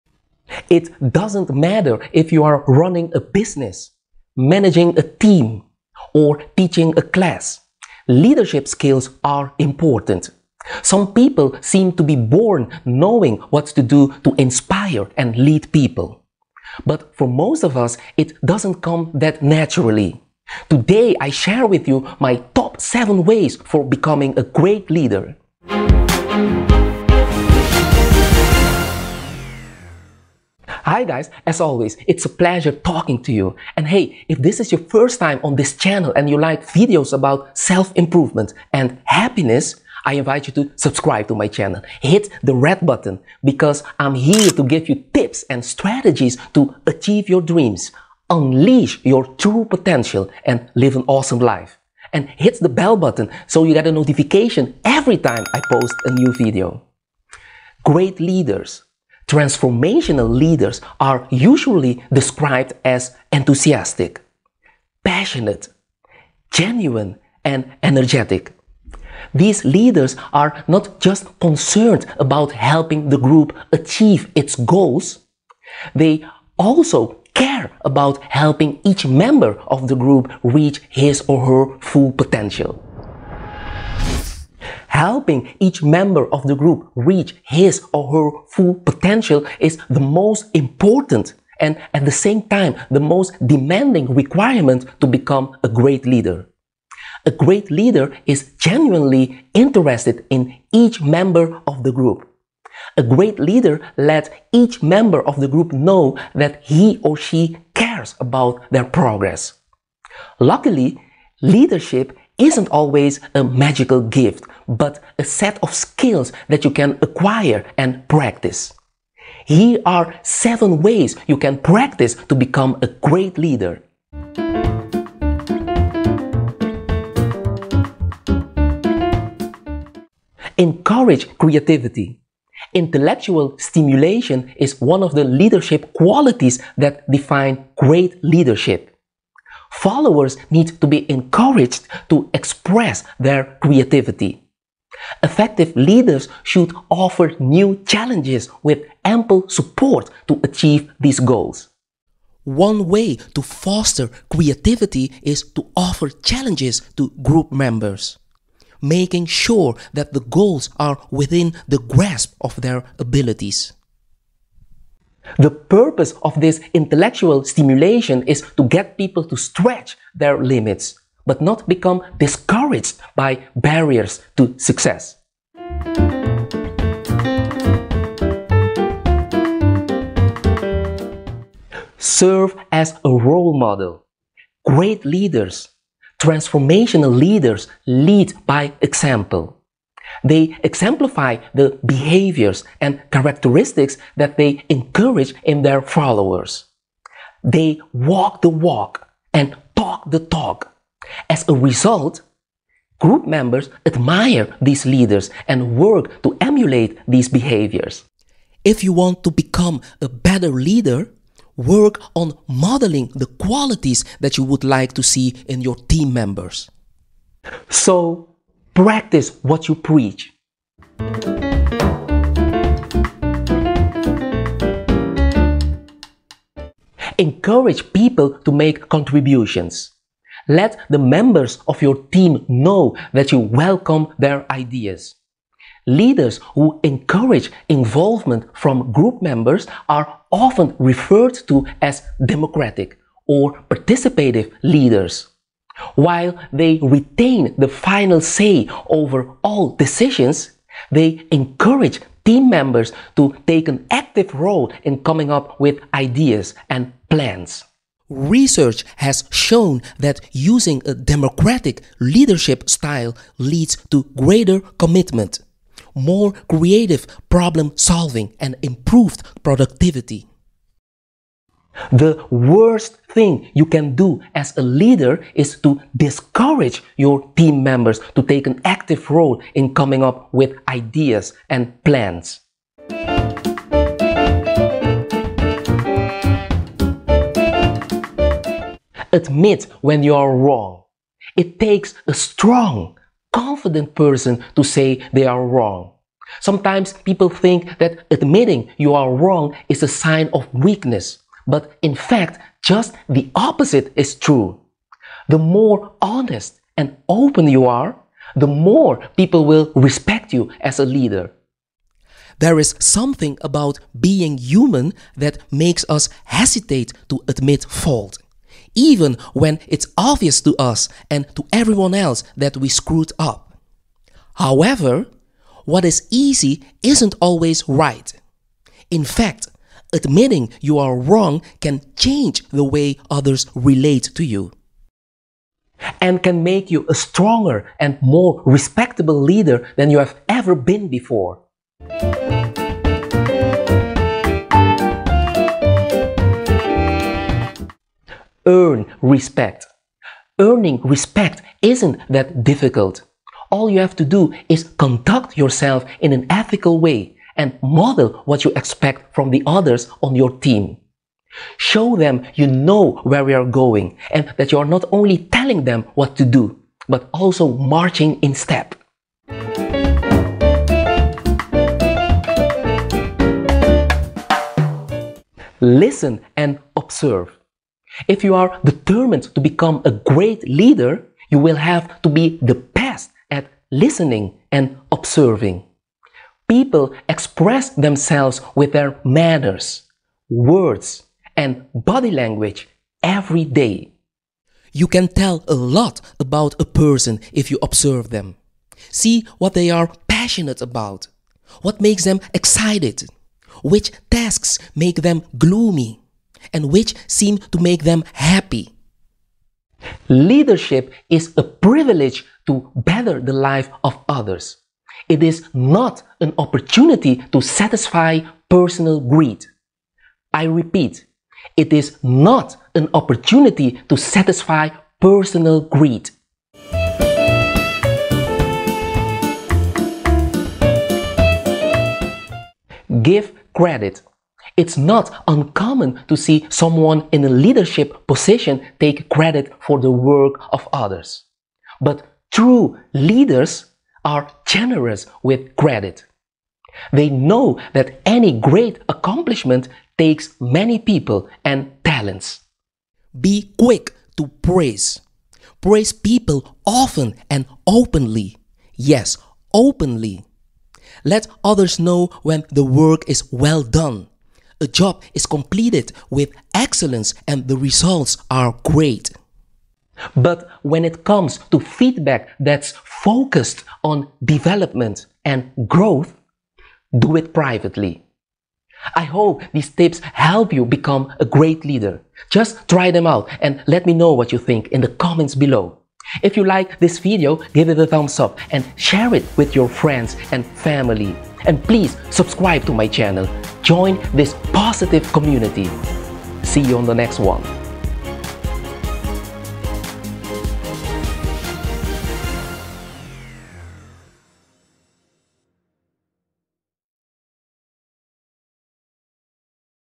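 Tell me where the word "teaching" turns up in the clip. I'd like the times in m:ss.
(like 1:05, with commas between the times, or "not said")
0:06.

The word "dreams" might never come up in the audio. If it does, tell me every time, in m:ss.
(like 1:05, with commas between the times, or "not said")
0:47.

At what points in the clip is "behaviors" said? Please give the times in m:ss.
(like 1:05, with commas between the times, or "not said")
3:11, 3:27.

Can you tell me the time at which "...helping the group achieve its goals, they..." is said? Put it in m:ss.
1:12.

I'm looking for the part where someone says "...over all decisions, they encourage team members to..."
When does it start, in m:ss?
4:08.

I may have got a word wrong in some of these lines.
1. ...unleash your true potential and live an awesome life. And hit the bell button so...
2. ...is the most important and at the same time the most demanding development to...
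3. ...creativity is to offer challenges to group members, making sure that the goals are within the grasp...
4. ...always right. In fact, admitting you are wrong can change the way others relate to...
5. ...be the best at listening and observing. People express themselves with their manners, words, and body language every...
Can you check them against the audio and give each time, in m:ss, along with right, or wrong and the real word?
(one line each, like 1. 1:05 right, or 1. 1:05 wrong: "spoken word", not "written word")
1. 0:48 right
2. 1:29 wrong: "requirement", not "development"
3. 2:34 right
4. 5:27 right
5. 6:22 right.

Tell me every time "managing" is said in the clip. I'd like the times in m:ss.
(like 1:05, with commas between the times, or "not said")
0:04.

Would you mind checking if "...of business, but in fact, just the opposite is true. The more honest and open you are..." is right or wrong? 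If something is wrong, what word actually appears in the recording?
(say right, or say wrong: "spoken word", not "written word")
wrong: "weakness", not "business".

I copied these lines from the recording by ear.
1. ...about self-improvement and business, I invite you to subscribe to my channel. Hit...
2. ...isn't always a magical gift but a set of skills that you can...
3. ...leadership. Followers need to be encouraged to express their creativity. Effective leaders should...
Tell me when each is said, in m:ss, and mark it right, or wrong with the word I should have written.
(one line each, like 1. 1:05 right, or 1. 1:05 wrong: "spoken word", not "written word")
1. 0:37 wrong: "happiness", not "business"
2. 1:52 right
3. 2:18 right.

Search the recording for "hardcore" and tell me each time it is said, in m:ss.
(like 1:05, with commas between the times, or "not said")
not said.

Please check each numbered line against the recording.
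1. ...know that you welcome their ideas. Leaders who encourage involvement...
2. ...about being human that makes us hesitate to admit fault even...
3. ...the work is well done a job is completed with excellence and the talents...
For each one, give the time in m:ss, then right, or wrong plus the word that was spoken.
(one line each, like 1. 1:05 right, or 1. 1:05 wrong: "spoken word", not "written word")
1. 3:52 right
2. 5:13 right
3. 7:42 wrong: "results", not "talents".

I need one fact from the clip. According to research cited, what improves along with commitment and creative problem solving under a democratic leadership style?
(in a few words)
Productivity.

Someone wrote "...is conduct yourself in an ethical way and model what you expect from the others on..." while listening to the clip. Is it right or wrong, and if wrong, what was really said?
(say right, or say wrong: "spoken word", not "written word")
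right.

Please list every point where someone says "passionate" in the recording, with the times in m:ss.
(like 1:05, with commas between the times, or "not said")
1:05, 6:40.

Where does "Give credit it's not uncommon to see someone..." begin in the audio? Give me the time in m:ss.
7:13.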